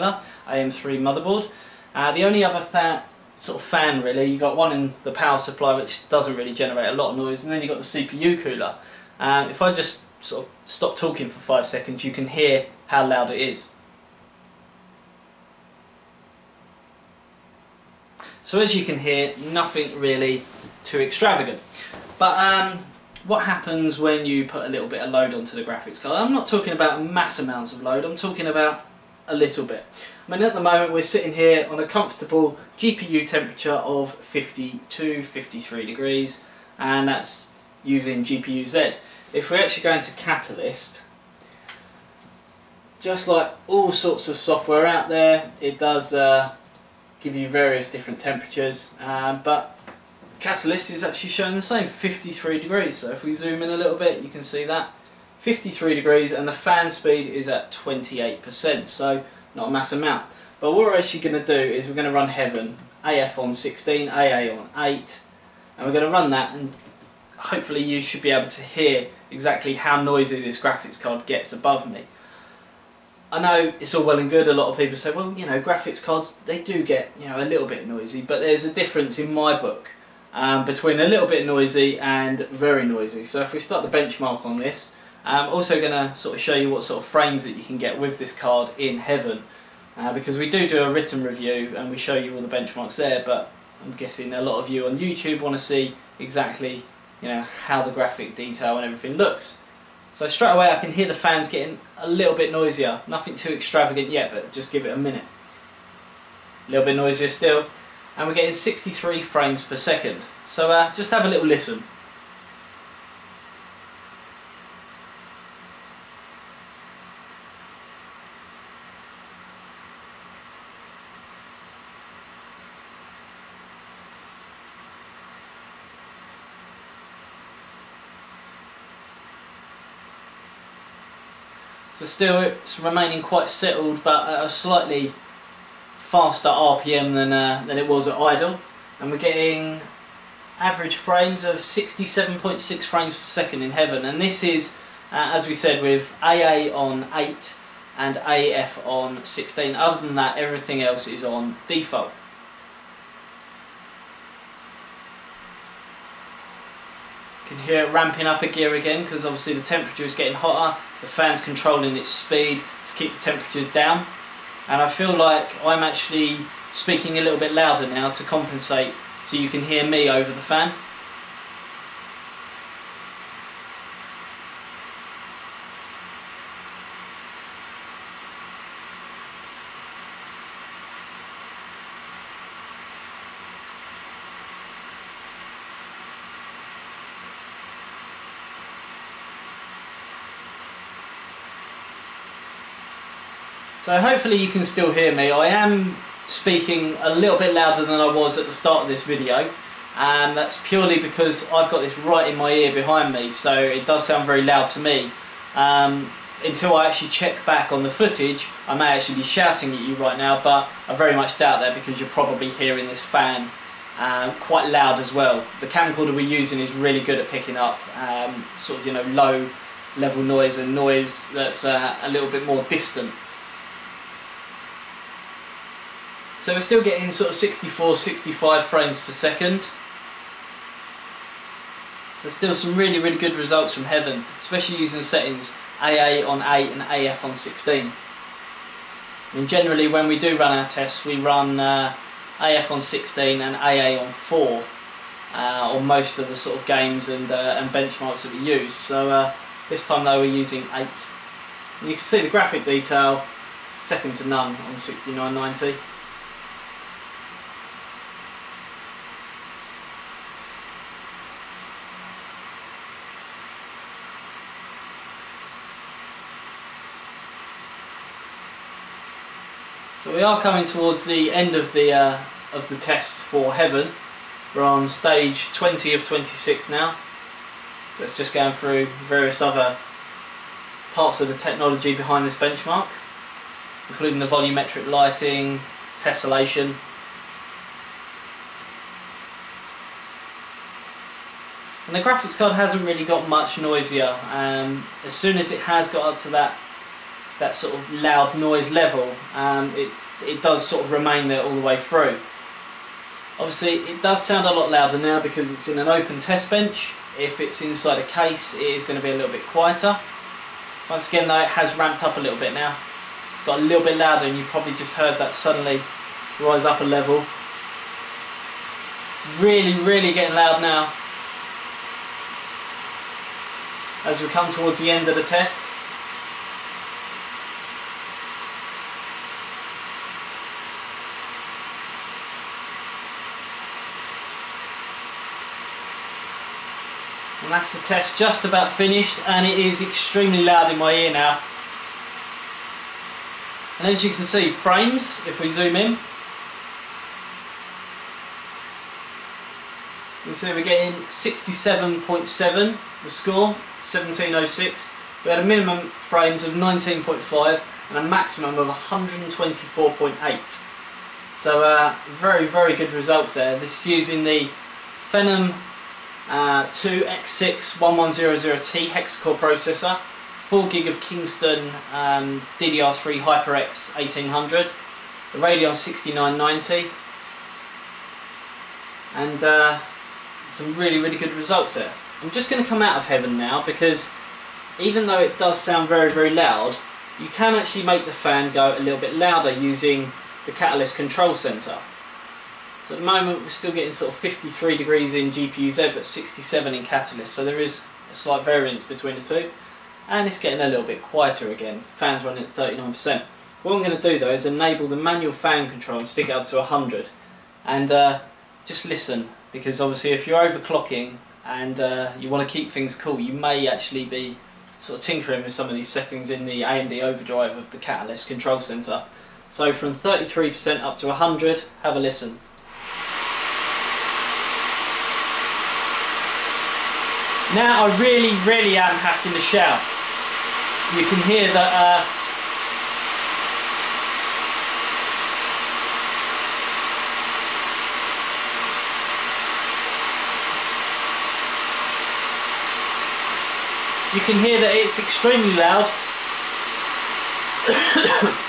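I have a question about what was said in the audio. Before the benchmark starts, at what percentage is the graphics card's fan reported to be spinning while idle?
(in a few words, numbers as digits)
28%.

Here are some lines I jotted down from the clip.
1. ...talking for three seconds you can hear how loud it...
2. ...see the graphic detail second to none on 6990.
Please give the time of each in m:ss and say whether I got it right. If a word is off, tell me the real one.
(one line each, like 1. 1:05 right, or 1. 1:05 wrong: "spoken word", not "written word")
1. 0:10 wrong: "five", not "three"
2. 4:12 right.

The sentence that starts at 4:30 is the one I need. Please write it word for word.
we are coming towards the end of the uh, of the tests for Heaven.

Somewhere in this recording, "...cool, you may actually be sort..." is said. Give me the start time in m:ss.
6:52.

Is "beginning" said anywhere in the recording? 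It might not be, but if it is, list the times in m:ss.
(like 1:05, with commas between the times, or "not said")
not said.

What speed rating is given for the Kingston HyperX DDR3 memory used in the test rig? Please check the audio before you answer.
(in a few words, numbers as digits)
1800.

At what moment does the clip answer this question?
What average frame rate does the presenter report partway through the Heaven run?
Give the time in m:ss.
2:21.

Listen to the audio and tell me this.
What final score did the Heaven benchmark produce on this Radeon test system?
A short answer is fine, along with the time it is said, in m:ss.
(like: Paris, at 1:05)
1706, at 5:53.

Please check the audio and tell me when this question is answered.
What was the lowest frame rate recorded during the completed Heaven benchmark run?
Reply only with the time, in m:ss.
5:56.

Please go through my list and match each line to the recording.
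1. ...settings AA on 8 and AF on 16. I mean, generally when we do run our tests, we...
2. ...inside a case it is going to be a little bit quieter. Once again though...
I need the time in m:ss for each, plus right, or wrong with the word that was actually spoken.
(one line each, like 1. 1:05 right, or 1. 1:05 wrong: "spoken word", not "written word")
1. 3:55 right
2. 5:07 right.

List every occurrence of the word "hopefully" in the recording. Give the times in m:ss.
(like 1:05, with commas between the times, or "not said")
1:07, 3:13.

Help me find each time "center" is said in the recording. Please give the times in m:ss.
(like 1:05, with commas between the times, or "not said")
6:31, 6:58.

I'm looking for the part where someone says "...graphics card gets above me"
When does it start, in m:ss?
1:10.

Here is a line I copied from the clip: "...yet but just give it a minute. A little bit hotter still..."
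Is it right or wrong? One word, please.
wrong.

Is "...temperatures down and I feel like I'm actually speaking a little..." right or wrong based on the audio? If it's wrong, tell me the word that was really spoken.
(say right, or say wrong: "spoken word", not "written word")
right.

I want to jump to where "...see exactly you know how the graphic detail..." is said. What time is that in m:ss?
1:35.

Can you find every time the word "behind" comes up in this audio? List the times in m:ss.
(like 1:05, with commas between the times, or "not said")
3:22, 4:41.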